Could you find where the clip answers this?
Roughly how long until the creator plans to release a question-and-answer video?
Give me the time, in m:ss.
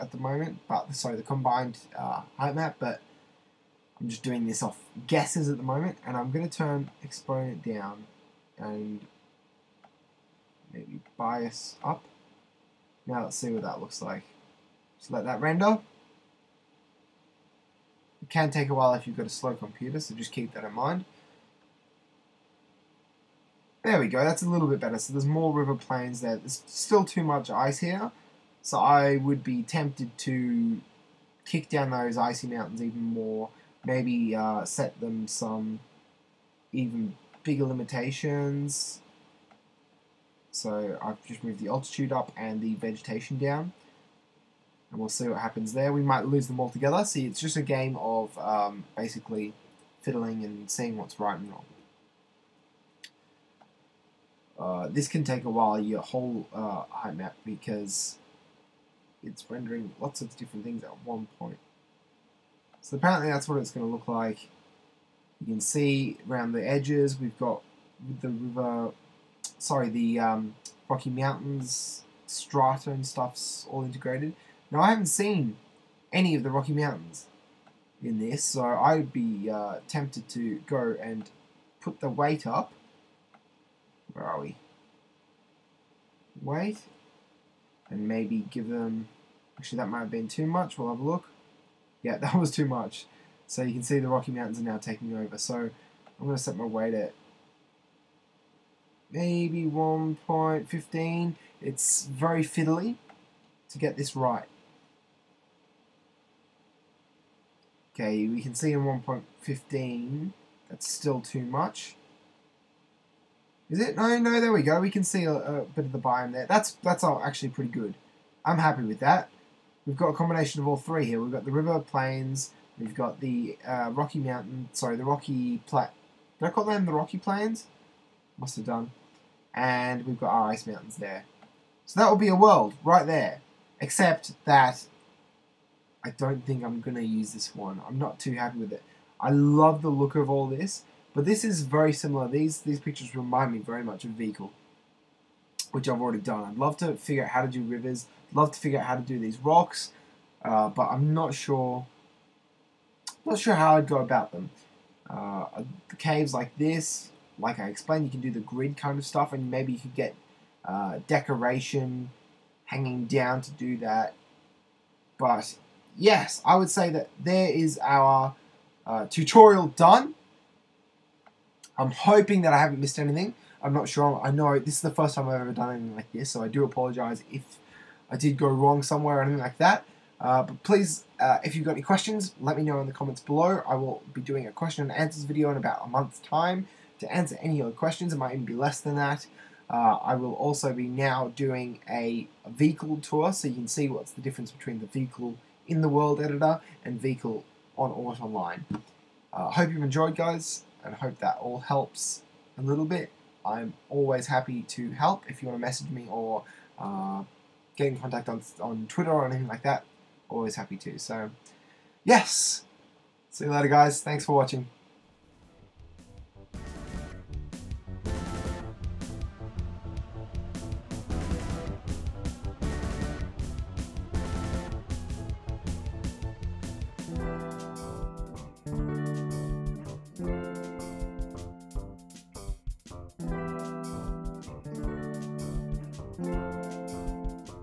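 3:05.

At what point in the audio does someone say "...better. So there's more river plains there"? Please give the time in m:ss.
0:24.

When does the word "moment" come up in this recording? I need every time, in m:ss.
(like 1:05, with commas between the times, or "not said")
0:00, 0:05.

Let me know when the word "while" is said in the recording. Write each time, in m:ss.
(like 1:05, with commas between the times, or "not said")
0:18, 0:55.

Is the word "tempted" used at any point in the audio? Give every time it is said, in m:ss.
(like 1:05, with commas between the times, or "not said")
0:29, 1:19.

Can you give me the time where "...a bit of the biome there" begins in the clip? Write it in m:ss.
1:55.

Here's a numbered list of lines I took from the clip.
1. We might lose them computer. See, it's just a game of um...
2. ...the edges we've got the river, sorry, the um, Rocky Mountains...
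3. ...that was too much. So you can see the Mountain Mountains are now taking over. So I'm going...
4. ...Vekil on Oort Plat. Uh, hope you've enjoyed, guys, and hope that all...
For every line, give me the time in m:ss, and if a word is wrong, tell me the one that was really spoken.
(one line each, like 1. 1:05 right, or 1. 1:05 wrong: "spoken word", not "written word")
1. 0:45 wrong: "altogether", not "computer"
2. 1:06 right
3. 1:32 wrong: "Rocky", not "Mountain"
4. 3:17 wrong: "Online", not "Plat".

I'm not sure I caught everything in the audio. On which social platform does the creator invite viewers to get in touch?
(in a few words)
Twitter.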